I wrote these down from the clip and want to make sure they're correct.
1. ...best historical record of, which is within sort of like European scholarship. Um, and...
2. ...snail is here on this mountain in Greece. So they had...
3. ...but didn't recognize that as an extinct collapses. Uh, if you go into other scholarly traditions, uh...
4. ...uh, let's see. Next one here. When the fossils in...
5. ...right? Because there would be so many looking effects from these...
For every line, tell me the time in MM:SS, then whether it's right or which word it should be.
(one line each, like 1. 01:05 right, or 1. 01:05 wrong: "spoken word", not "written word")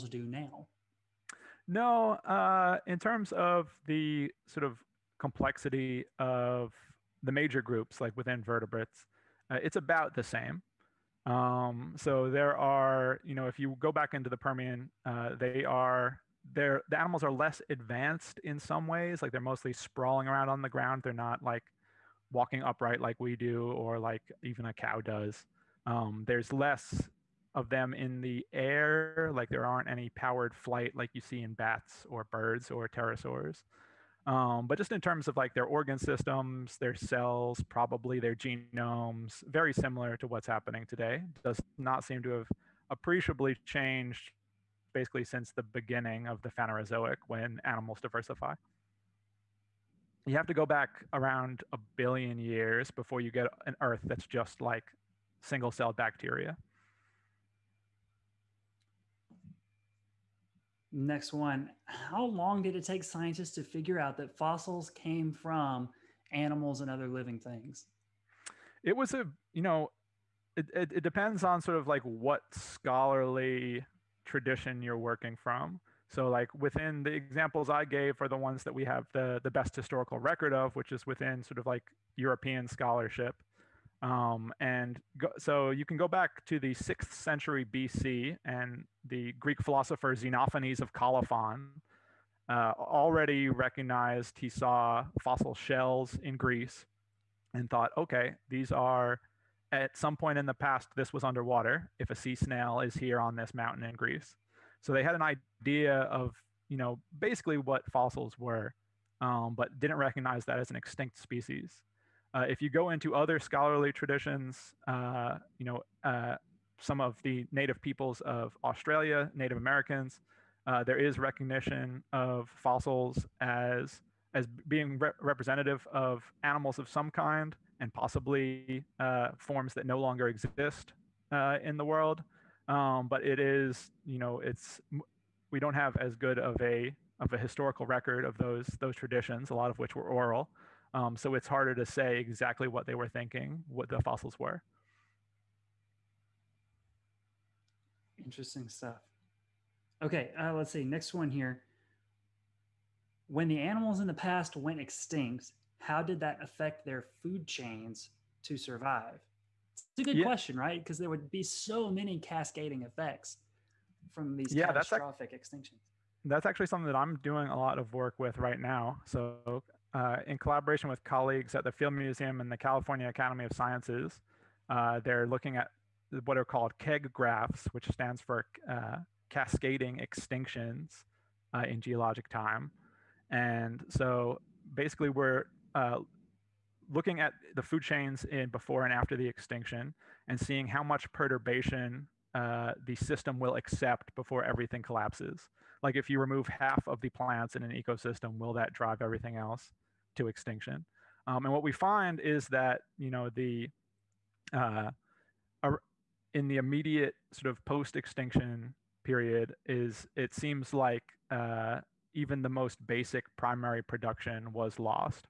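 1. 01:19 right
2. 01:42 right
3. 01:49 wrong: "species", not "collapses"
4. 02:30 wrong: "animals", not "fossils"
5. 02:40 wrong: "cascading", not "looking".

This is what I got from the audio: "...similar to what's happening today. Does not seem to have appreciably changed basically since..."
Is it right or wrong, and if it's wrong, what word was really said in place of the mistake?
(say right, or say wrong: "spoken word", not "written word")
right.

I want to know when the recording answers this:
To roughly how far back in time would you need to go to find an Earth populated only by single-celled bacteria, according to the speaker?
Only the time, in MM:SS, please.
00:51.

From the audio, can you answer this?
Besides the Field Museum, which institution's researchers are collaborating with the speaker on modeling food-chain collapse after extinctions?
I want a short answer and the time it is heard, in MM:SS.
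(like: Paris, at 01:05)
California Academy of Sciences, at 02:52.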